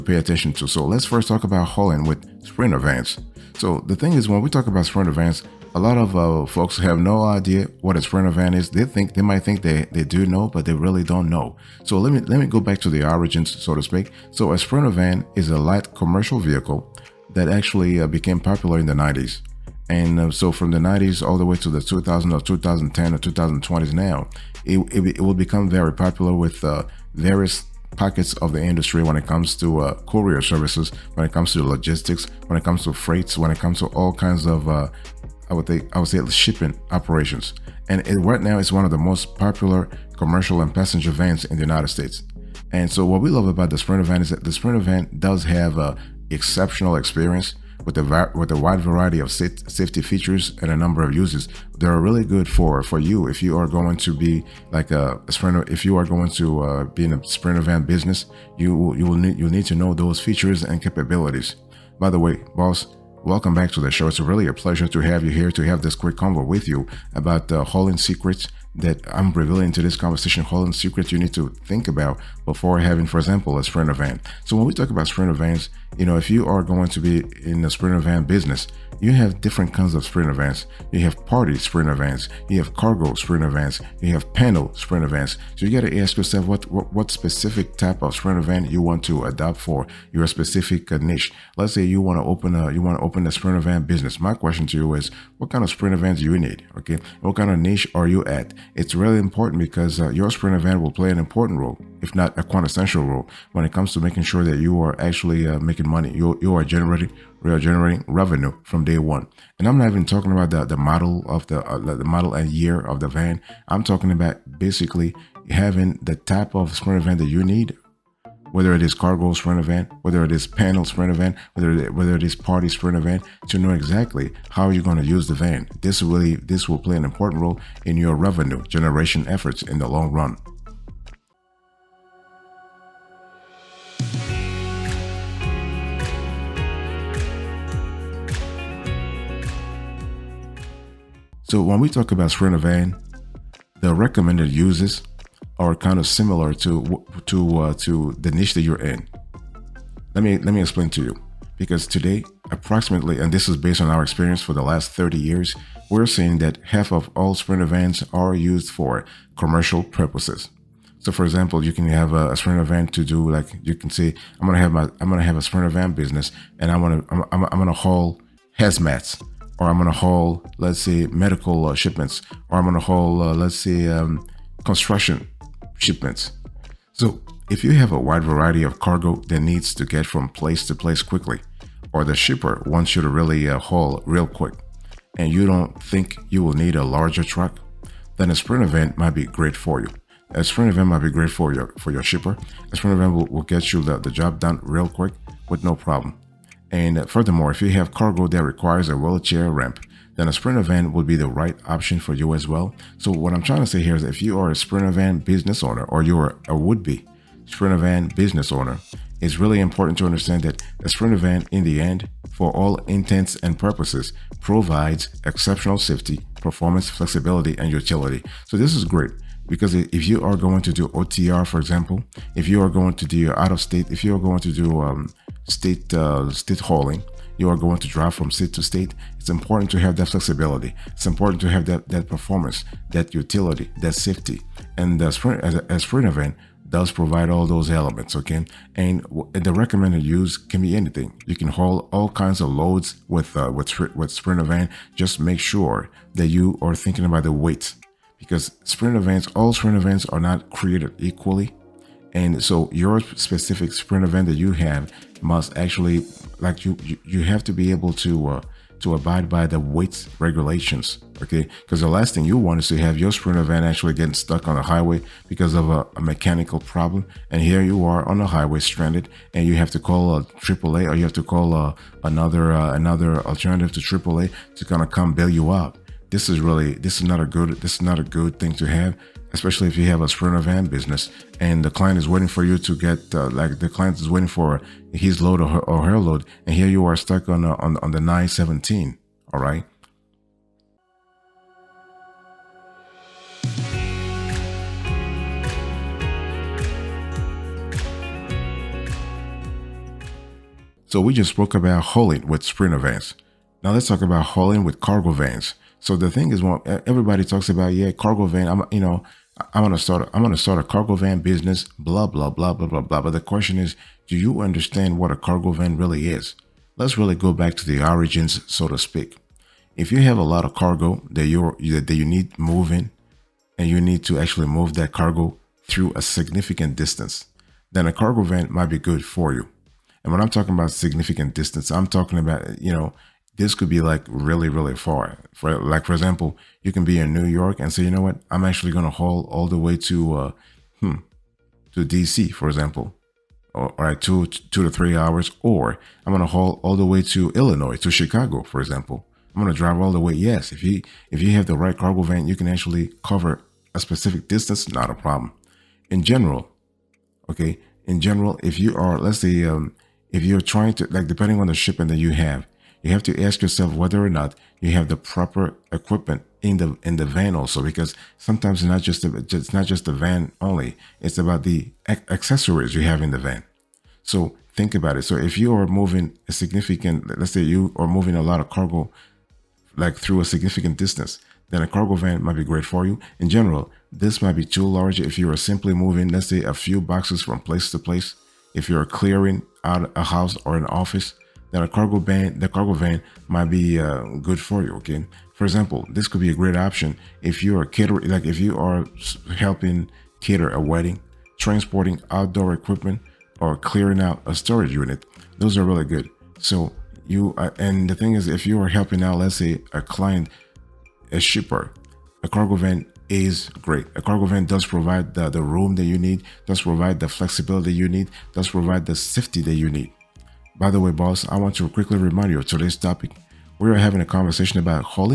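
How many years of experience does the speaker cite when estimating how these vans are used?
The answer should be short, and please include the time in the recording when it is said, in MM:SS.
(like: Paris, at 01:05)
30, at 02:34.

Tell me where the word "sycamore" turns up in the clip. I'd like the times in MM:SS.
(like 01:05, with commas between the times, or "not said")
not said.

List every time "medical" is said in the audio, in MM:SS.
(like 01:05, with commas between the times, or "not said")
02:51.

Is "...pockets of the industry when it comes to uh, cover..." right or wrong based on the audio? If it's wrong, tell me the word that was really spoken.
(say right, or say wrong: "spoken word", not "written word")
wrong: "courier", not "cover".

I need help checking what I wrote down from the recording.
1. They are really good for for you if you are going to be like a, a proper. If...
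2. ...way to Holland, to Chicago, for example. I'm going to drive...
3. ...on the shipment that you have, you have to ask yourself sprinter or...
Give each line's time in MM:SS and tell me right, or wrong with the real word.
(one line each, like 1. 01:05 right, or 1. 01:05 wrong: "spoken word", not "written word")
1. 00:51 wrong: "sprinter", not "proper"
2. 05:46 wrong: "Illinois", not "Holland"
3. 06:01 wrong: "whether", not "sprinter".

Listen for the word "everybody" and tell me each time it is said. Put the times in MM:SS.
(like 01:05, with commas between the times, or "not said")
05:06.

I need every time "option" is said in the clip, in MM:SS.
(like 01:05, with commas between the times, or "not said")
03:21, 06:36.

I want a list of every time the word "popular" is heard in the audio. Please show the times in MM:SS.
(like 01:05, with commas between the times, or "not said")
00:18, 00:25, 00:39.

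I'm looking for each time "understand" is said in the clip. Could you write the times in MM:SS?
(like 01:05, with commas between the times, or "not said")
03:30, 05:14.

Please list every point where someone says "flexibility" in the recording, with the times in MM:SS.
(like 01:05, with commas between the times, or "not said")
03:36, 03:50, 06:57.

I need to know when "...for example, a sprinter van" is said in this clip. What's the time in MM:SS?
01:13.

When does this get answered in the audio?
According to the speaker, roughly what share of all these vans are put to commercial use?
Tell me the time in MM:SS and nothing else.
02:36.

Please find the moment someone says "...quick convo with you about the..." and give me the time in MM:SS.
01:05.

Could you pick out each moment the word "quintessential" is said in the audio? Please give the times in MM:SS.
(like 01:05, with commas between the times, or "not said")
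01:42.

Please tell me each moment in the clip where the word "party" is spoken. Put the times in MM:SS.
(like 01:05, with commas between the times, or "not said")
01:21, 02:02.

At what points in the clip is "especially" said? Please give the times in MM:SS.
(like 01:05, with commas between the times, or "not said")
04:39.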